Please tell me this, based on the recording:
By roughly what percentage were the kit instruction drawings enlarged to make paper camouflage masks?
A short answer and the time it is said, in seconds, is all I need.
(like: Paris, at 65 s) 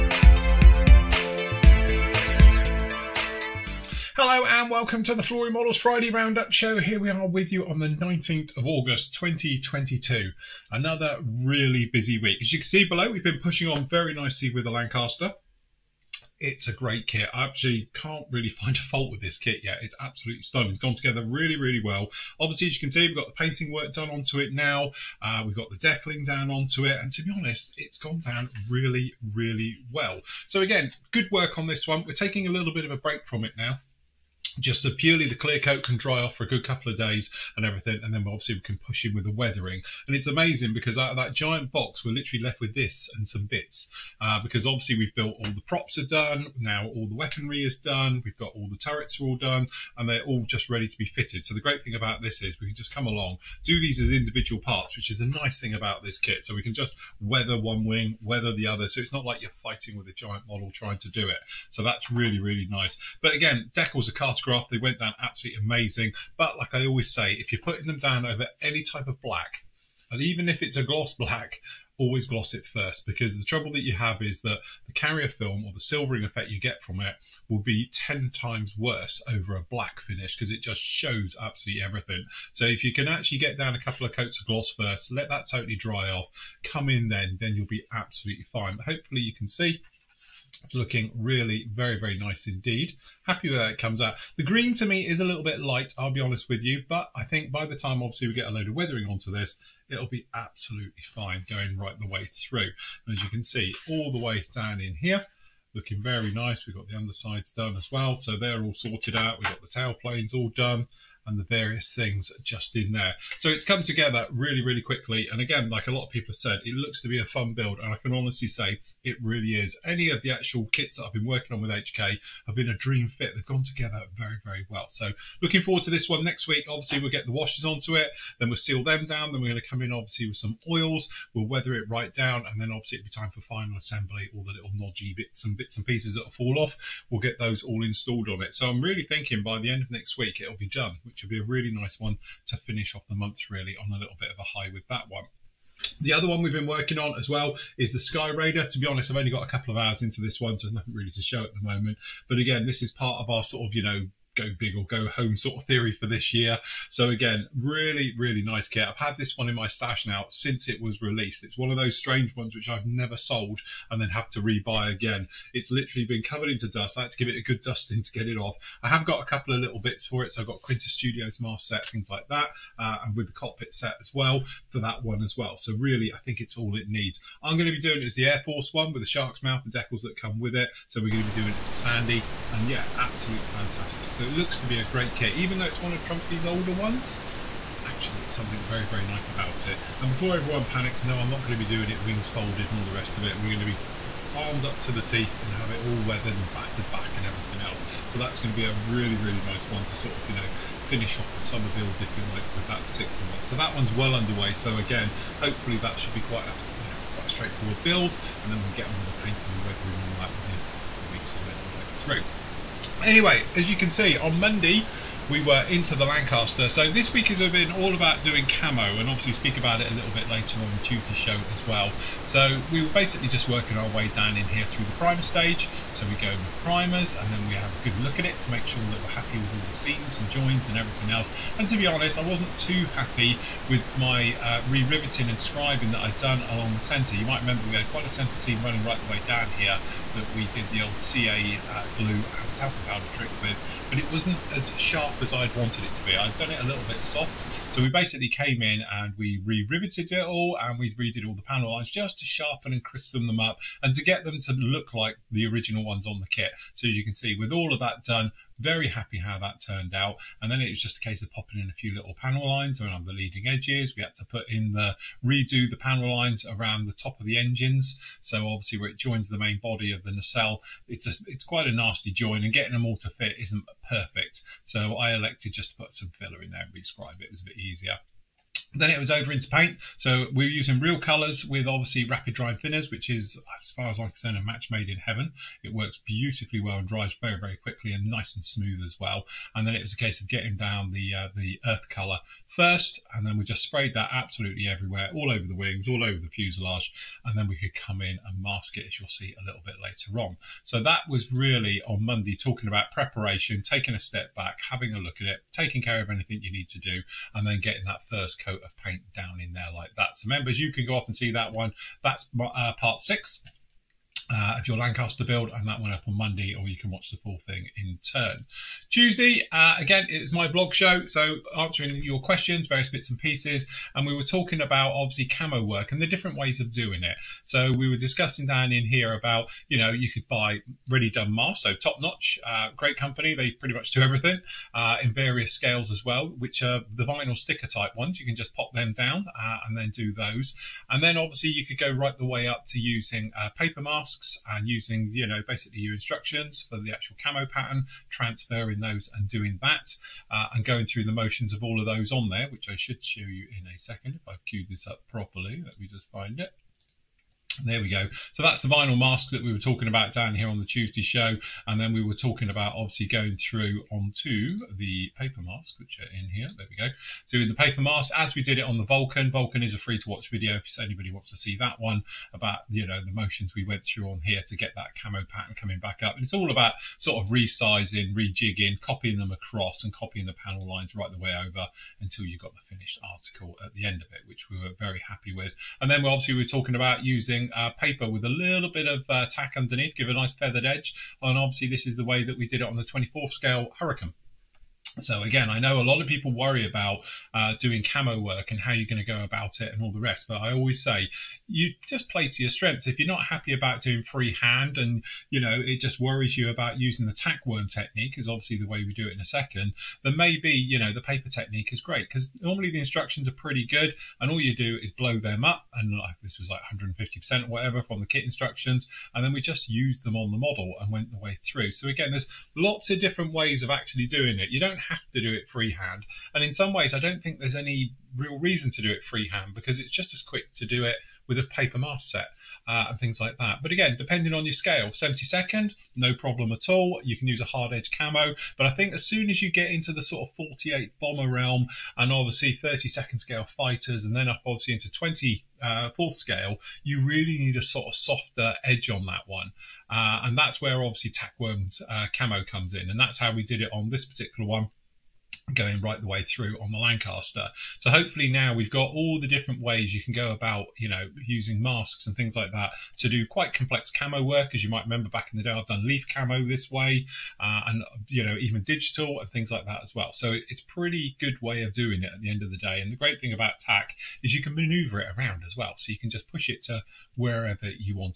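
150 percent, at 416 s.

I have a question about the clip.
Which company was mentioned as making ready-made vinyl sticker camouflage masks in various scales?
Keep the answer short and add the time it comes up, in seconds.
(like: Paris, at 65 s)
Top Notch, at 331 s.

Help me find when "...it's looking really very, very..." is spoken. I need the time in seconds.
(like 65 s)
90 s.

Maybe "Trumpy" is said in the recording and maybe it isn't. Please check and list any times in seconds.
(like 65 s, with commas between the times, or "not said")
186 s.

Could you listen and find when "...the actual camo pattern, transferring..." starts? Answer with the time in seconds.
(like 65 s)
346 s.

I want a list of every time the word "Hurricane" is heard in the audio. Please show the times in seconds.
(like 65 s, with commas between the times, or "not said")
393 s.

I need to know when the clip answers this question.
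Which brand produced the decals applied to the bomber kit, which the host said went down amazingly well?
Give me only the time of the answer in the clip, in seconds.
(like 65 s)
64 s.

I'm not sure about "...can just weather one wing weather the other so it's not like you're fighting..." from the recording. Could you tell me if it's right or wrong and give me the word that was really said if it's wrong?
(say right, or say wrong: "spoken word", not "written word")
right.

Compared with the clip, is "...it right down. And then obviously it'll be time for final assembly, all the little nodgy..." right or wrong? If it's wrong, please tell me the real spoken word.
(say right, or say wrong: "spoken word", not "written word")
right.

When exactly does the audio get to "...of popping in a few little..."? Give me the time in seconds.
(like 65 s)
261 s.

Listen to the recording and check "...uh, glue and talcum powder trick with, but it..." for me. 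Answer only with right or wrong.
right.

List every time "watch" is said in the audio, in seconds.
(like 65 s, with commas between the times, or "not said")
316 s, 370 s.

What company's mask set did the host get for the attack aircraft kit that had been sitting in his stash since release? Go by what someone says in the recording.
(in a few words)
Quinta Studios.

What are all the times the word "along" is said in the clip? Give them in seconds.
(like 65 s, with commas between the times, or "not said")
53 s, 236 s.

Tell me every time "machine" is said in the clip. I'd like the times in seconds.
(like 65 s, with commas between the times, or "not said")
not said.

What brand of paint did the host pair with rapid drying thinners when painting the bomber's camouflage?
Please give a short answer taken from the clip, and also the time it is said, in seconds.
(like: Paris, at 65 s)
Real Colors, at 280 s.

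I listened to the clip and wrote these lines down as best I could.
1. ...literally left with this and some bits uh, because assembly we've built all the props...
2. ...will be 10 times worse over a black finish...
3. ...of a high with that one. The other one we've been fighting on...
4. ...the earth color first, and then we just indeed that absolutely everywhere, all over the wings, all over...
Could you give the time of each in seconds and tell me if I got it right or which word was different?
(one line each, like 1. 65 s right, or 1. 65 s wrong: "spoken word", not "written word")
1. 42 s wrong: "obviously", not "assembly"
2. 77 s right
3. 144 s wrong: "working", not "fighting"
4. 291 s wrong: "sprayed", not "indeed".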